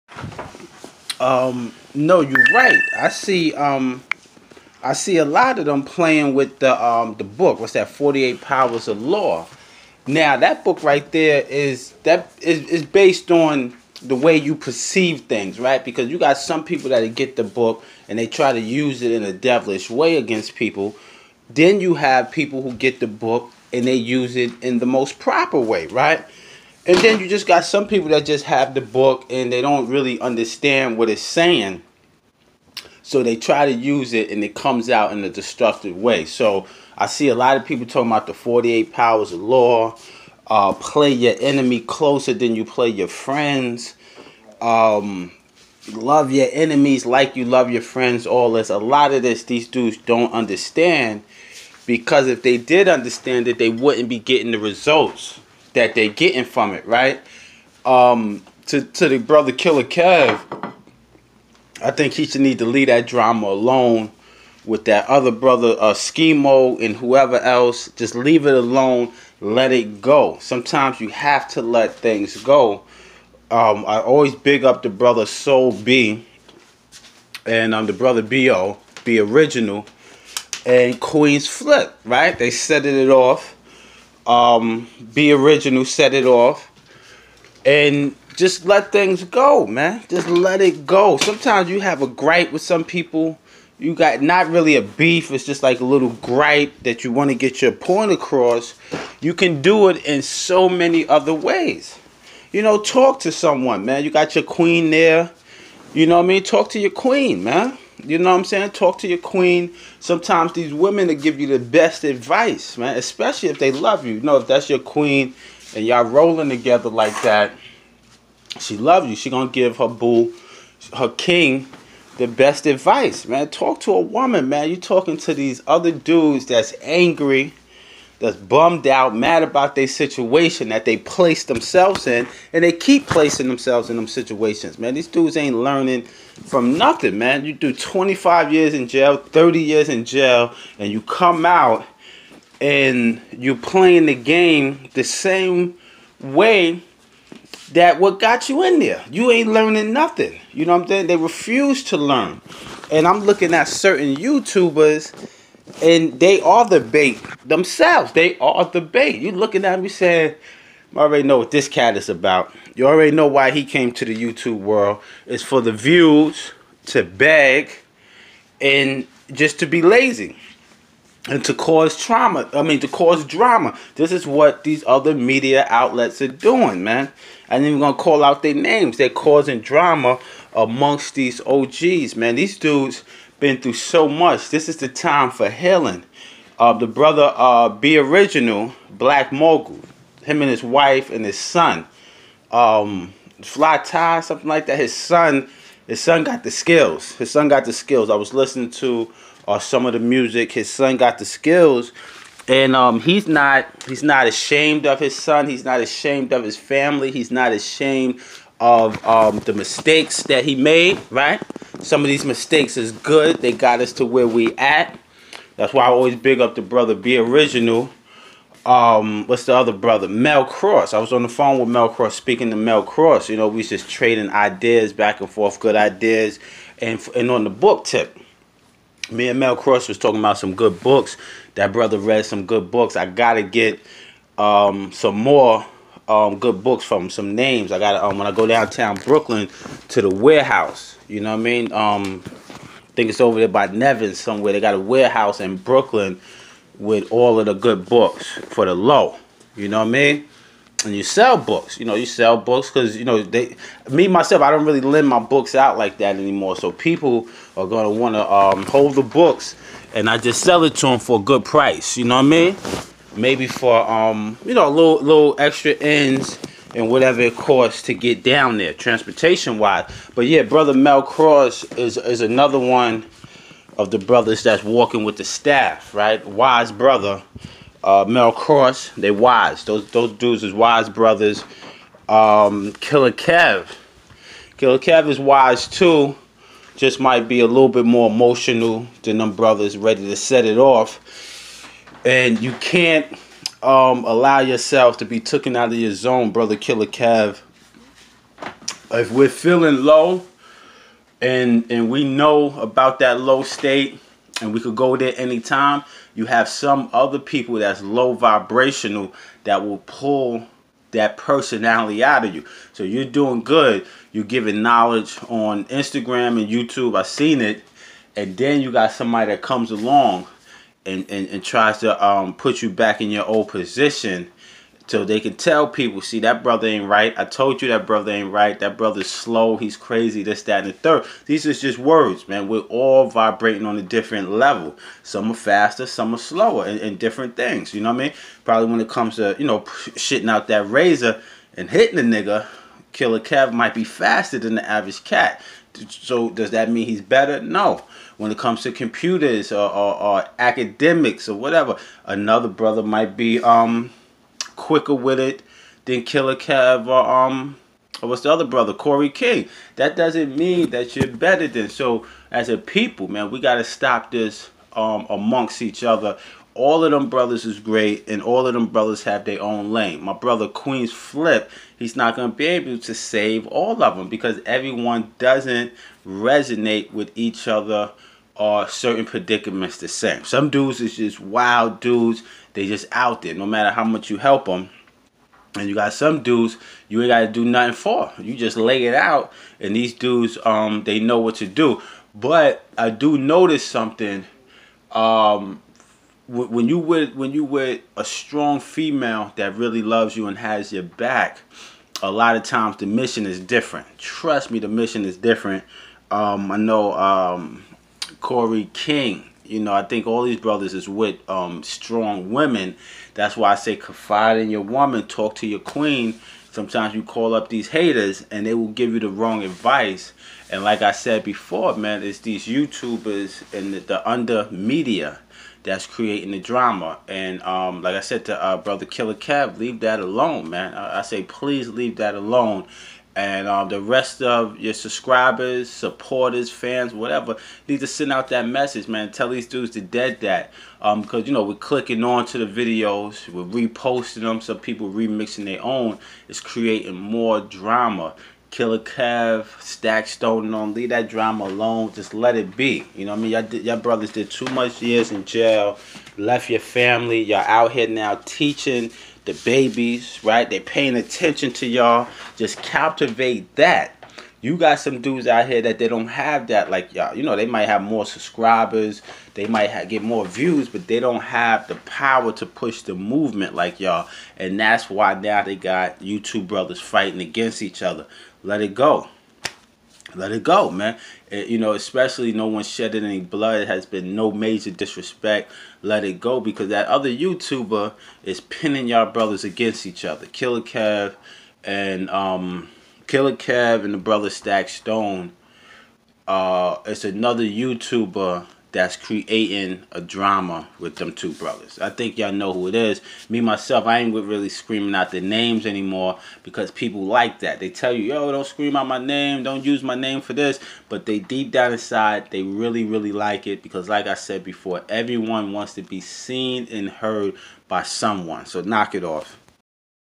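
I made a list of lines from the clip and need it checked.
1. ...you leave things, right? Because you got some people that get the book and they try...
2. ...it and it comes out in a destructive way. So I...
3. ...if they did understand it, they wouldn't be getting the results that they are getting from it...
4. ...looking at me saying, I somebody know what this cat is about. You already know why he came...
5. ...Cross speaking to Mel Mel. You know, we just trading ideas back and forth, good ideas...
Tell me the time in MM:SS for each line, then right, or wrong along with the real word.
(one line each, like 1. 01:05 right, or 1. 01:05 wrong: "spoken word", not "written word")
1. 00:14 wrong: "perceive", not "leave"
2. 00:34 right
3. 00:52 right
4. 02:39 wrong: "already", not "somebody"
5. 03:41 wrong: "Cross", not "Mel".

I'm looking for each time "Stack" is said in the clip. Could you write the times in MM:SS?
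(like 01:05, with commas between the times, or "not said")
07:29, 08:14.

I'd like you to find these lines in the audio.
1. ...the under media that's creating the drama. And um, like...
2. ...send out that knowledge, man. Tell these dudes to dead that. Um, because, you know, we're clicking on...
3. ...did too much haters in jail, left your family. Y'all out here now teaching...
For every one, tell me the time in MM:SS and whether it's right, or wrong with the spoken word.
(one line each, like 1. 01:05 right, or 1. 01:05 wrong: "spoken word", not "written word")
1. 07:03 right
2. 07:17 wrong: "message", not "knowledge"
3. 07:34 wrong: "years", not "haters".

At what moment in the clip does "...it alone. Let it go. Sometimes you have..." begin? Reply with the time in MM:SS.
01:08.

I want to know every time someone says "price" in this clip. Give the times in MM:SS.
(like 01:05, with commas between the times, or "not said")
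04:21.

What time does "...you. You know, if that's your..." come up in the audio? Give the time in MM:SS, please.
01:54.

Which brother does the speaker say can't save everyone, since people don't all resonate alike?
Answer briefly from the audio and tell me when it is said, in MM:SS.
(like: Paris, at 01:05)
Queens Flip, at 06:10.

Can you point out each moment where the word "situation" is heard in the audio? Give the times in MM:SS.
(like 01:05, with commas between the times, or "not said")
02:09, 02:14.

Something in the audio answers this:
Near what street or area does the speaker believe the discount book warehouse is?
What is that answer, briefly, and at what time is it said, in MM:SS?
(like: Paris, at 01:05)
Nevin, at 04:03.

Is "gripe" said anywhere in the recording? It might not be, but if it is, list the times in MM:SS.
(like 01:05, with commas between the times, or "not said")
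01:32, 01:36.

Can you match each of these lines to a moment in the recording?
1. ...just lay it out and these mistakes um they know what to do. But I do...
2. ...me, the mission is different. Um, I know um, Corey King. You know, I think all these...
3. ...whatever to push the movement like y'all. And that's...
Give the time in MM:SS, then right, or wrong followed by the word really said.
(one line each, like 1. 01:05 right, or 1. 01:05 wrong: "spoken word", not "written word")
1. 06:28 wrong: "dudes", not "mistakes"
2. 06:44 right
3. 07:51 wrong: "power", not "whatever".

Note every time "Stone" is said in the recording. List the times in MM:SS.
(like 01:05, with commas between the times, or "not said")
07:30, 08:14.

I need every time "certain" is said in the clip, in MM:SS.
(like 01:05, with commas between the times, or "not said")
02:33, 06:18.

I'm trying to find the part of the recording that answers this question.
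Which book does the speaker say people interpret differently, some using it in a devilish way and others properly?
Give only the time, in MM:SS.
00:07.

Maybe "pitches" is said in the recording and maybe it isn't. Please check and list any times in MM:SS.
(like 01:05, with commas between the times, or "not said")
not said.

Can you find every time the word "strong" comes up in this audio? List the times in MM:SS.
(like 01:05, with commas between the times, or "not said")
06:38, 06:51.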